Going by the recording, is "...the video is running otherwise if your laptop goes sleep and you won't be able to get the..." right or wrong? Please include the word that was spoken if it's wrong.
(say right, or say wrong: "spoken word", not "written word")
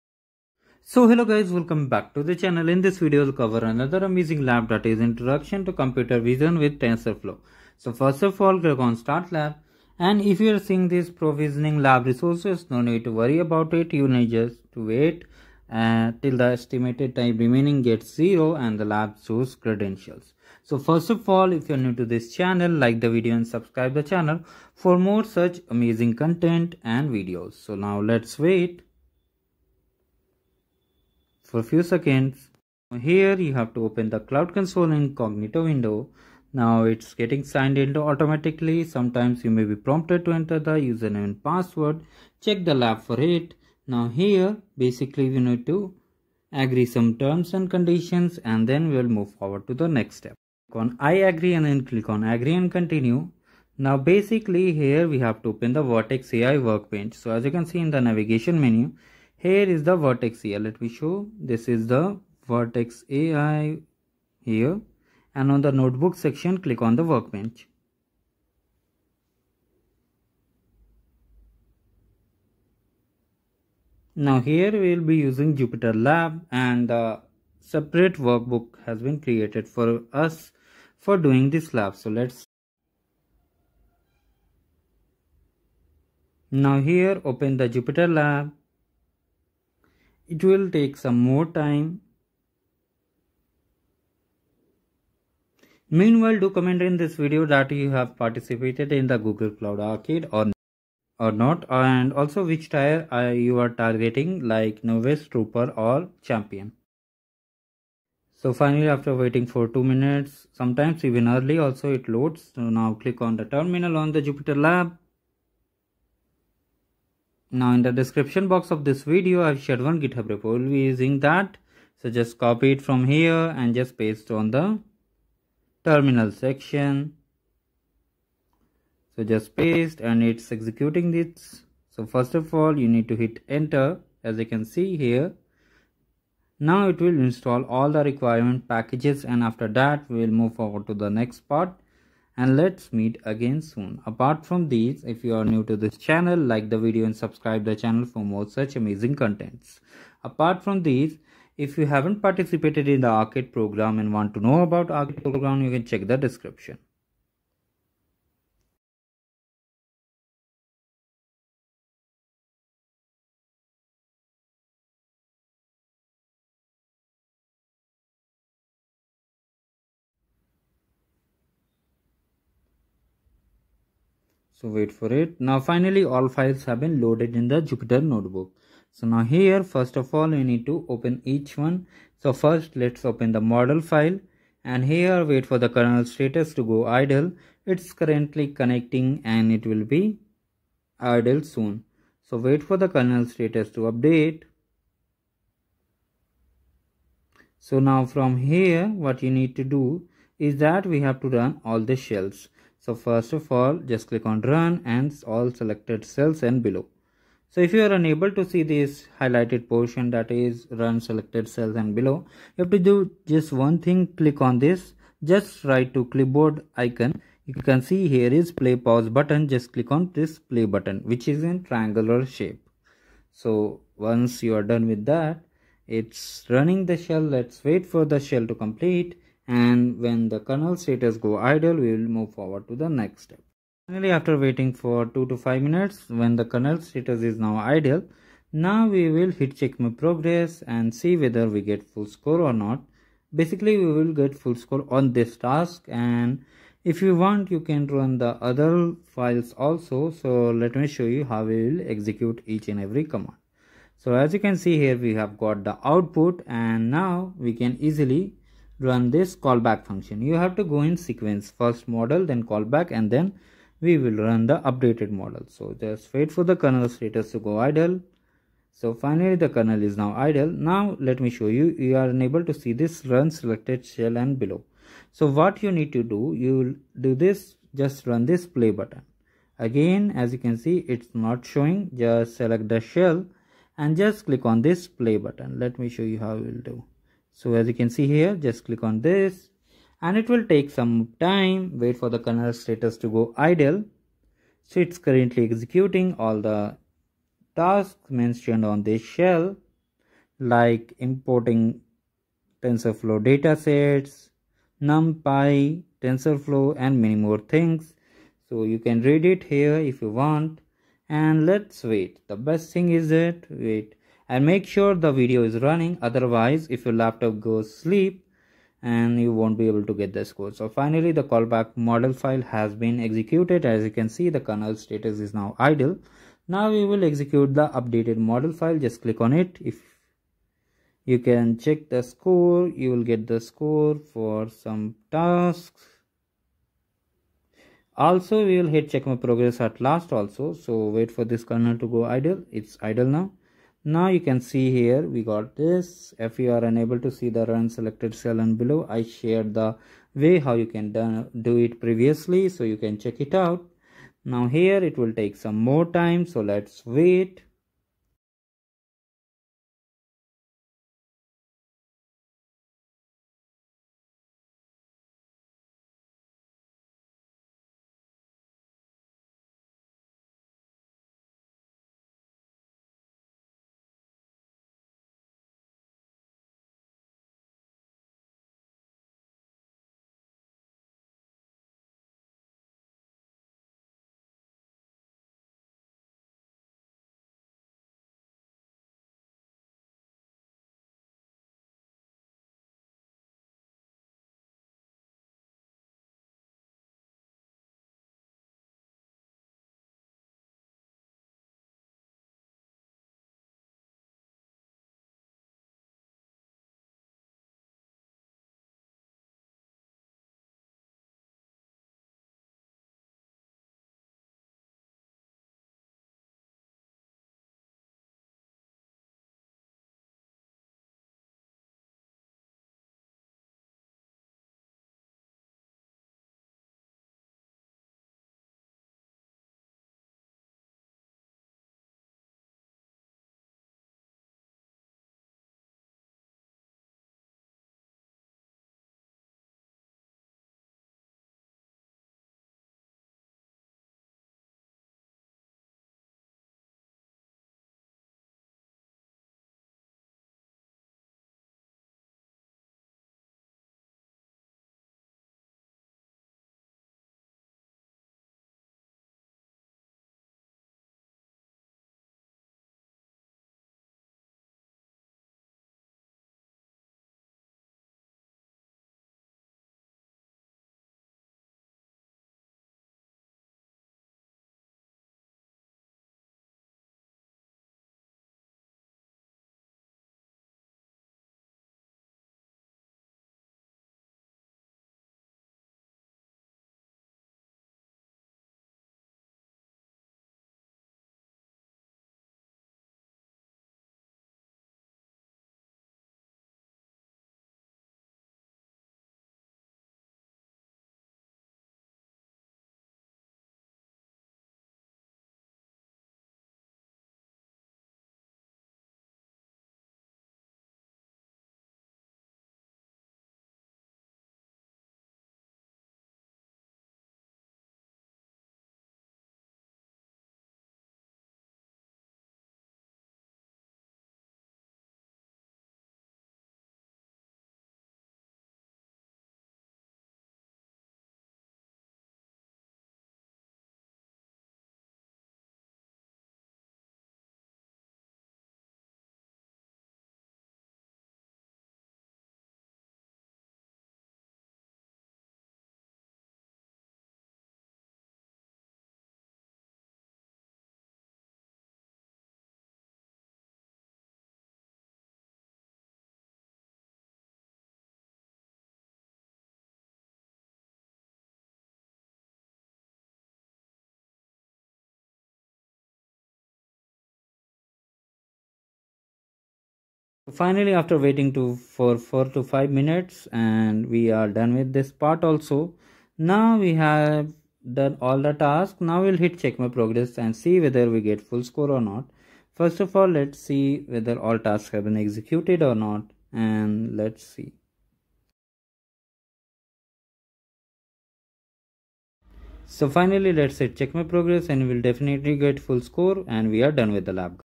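right.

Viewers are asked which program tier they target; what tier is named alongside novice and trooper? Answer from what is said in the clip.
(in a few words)
Champion.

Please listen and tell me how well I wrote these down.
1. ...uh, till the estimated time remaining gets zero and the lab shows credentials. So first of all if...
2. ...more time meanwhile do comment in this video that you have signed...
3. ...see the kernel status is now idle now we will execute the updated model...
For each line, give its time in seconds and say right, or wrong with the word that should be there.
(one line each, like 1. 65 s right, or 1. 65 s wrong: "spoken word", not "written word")
1. 15 s right
2. 91 s wrong: "participated", not "signed"
3. 324 s right.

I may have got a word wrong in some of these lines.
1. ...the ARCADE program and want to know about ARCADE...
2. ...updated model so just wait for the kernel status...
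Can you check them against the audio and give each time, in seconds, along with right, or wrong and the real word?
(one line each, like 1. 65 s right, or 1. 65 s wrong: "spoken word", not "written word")
1. 153 s right
2. 264 s right.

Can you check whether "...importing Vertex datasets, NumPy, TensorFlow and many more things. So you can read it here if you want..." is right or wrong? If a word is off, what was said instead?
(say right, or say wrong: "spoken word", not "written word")
wrong: "TensorFlow", not "Vertex".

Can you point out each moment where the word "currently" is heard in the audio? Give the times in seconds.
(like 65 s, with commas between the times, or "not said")
188 s, 295 s.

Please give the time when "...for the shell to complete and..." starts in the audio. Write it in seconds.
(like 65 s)
227 s.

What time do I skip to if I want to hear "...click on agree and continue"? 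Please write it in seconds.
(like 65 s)
51 s.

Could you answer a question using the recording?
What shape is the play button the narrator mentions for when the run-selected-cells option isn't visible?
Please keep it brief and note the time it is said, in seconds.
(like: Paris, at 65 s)
Triangular, at 221 s.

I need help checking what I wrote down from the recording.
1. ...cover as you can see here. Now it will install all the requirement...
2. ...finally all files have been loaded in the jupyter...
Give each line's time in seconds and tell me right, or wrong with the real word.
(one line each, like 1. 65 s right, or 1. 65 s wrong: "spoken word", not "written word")
1. 133 s wrong: "enter", not "cover"
2. 175 s right.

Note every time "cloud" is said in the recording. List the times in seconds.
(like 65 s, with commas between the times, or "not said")
34 s, 99 s.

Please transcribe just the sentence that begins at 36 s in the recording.
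Now it's getting signed into automatically.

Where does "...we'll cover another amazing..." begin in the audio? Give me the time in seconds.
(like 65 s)
3 s.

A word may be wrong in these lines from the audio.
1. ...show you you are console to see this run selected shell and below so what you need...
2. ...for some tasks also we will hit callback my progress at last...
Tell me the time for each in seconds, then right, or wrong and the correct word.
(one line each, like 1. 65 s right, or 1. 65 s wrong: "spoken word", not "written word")
1. 271 s wrong: "unable", not "console"
2. 334 s wrong: "check", not "callback".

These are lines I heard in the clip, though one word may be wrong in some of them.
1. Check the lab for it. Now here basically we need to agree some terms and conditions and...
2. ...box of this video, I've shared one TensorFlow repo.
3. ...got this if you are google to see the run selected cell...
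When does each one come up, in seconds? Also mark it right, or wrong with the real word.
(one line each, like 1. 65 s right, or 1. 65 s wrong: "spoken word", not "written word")
1. 42 s right
2. 118 s wrong: "GitHub", not "TensorFlow"
3. 345 s wrong: "unable", not "google".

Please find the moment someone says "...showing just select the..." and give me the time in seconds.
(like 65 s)
281 s.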